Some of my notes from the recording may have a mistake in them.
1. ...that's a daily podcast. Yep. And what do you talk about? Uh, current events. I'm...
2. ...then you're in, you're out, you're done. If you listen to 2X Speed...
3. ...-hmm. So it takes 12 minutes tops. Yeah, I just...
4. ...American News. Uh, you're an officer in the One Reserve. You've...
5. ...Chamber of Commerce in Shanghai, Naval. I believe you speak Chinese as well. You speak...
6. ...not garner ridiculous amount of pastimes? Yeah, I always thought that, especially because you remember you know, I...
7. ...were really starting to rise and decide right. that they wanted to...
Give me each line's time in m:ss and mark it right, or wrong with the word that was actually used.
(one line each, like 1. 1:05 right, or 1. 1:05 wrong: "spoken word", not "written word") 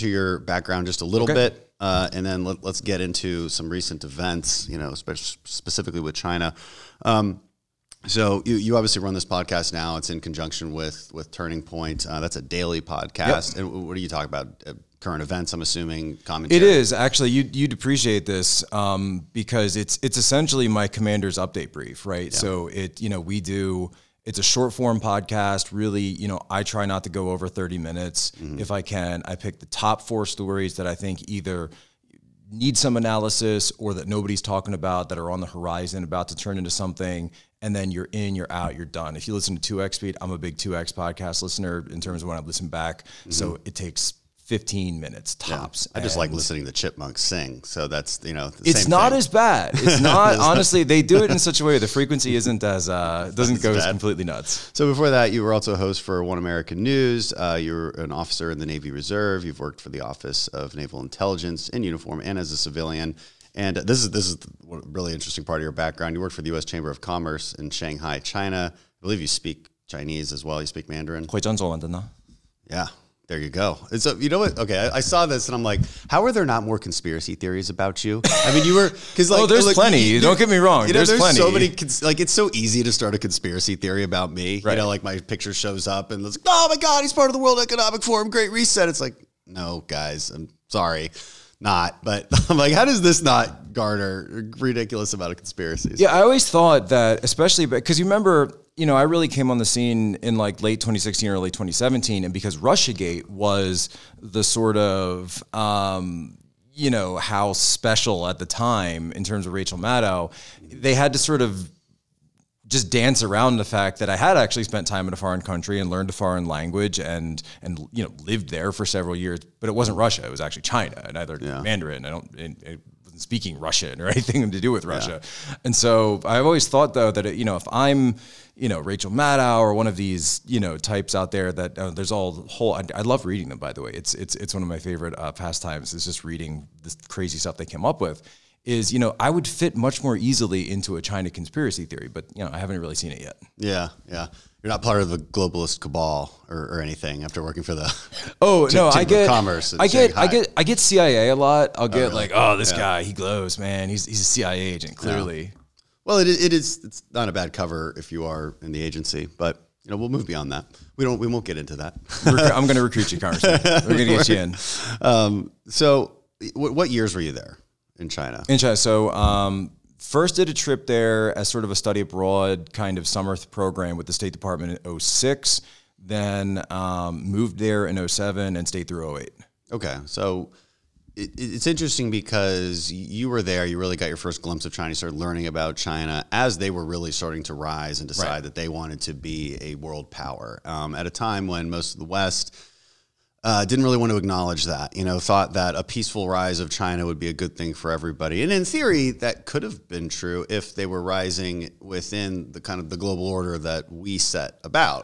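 1. 0:12 right
2. 0:37 right
3. 0:43 wrong: "15", not "12"
4. 0:56 wrong: "Navy", not "One"
5. 1:06 wrong: "China", not "Naval"
6. 1:33 wrong: "conspiracies", not "pastimes"
7. 3:06 right.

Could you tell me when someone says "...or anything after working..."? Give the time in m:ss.
2:26.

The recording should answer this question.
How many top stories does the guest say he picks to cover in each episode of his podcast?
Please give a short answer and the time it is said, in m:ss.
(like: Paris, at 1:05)
4, at 0:30.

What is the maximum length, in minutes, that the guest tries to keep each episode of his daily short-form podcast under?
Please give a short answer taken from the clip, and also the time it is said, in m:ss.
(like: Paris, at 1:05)
30, at 0:27.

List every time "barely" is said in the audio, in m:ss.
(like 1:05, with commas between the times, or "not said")
not said.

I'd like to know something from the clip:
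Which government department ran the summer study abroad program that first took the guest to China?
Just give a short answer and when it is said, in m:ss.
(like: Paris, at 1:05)
State Department, at 2:54.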